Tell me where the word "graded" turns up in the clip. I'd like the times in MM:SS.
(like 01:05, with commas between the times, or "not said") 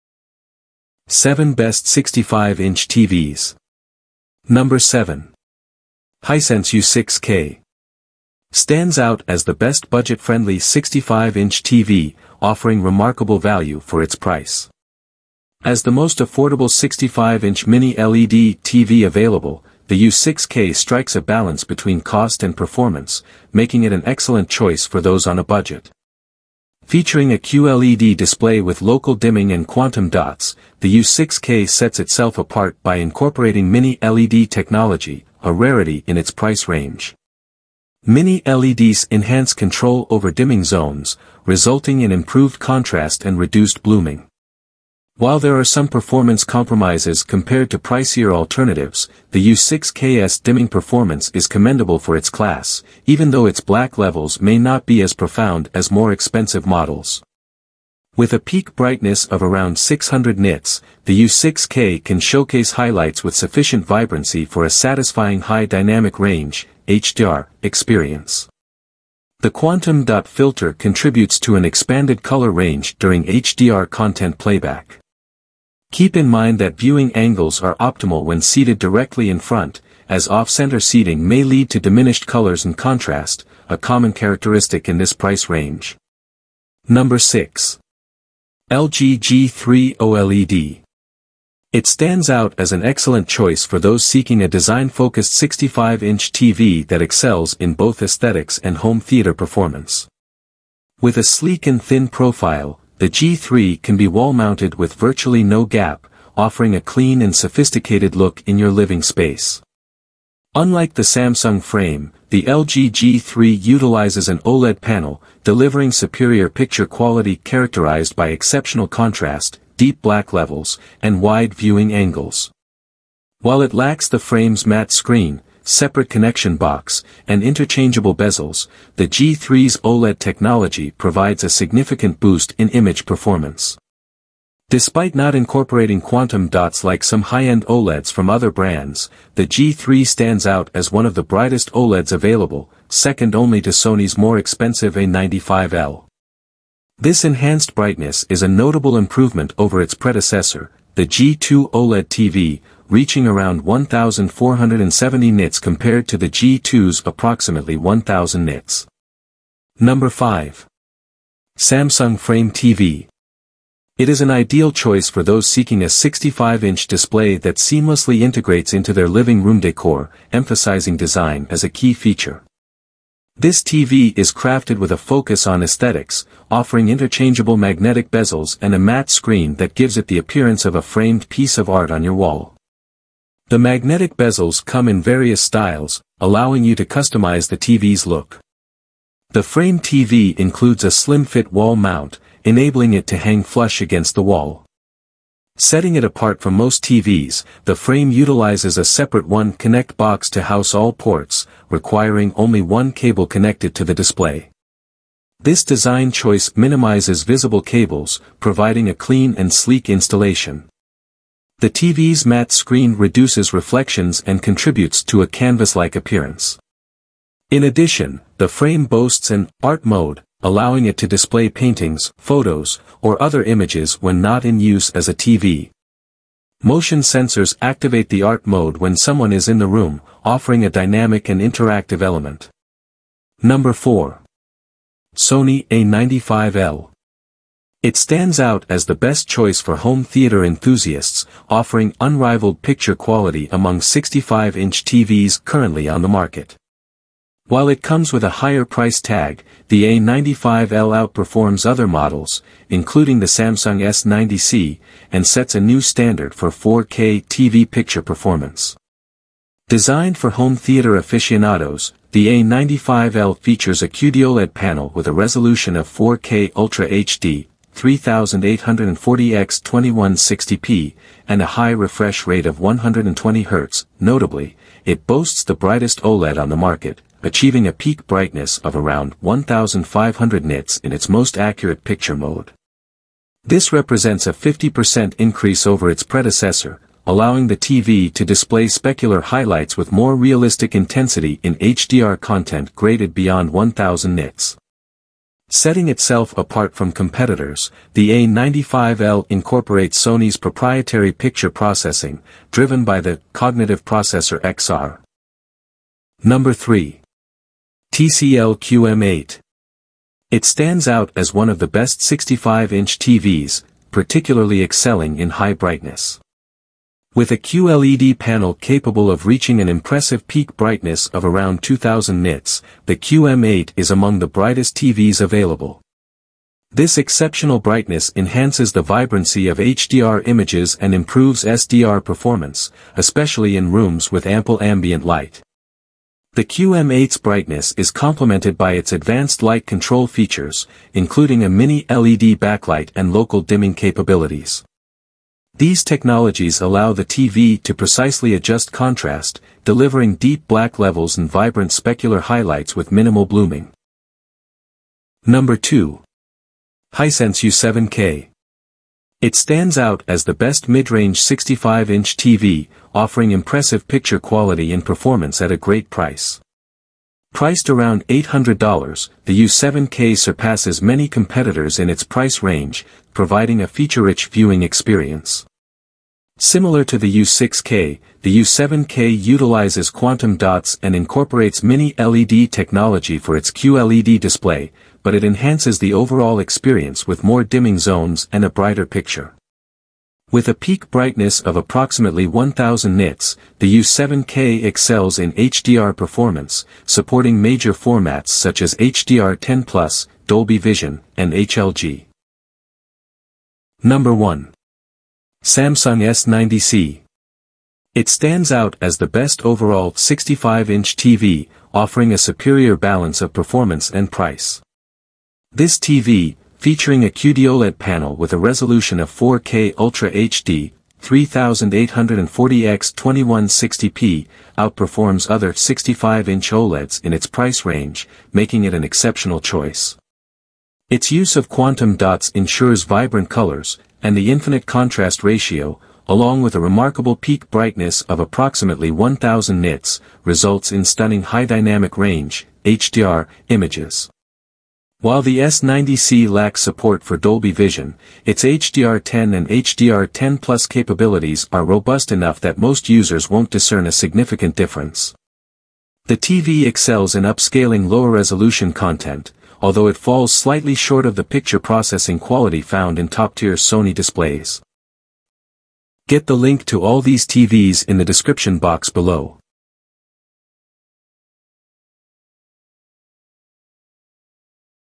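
04:52.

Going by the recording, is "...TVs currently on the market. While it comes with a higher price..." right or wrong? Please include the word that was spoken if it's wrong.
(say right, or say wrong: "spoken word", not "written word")
right.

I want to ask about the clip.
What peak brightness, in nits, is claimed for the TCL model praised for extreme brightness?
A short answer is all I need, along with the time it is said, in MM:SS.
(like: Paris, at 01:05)
2000 nits, at 05:21.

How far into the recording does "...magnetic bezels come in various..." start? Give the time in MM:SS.
03:03.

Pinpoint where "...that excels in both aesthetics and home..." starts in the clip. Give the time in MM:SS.
01:36.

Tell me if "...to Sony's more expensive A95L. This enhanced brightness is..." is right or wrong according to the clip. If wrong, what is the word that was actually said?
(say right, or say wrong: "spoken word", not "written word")
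right.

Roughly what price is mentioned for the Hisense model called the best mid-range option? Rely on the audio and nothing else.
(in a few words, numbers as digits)
$800.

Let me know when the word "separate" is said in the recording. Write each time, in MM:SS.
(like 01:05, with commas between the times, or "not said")
02:05, 03:18.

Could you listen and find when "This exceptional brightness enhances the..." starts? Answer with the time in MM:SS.
05:26.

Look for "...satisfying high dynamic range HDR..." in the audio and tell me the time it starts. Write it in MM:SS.
01:04.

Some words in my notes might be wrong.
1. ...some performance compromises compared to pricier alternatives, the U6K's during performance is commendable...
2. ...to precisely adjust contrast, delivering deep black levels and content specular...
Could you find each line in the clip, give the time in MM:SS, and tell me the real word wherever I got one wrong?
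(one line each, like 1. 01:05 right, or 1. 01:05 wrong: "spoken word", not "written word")
1. 00:45 wrong: "dimming", not "during"
2. 05:47 wrong: "vibrant", not "content".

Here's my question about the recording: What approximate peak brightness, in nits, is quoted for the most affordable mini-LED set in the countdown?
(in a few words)
600 nits.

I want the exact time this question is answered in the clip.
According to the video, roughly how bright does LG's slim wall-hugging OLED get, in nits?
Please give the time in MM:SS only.
02:33.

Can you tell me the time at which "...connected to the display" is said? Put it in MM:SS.
03:23.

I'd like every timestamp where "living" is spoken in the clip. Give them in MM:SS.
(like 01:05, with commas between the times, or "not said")
01:48, 02:49.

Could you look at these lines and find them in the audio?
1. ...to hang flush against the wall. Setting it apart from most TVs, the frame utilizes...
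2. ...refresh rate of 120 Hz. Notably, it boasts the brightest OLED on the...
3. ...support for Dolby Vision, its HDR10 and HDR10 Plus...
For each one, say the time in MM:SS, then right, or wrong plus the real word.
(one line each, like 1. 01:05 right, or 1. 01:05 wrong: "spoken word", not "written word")
1. 03:13 right
2. 04:31 right
3. 07:26 right.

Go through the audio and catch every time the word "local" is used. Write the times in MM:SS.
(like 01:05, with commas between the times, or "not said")
00:28, 05:43.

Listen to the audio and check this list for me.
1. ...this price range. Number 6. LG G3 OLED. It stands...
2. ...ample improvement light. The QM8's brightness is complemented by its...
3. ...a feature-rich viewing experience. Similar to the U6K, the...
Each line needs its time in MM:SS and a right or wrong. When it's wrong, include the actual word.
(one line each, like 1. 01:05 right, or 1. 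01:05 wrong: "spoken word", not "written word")
1. 01:24 right
2. 05:34 wrong: "ambient", not "improvement"
3. 06:13 right.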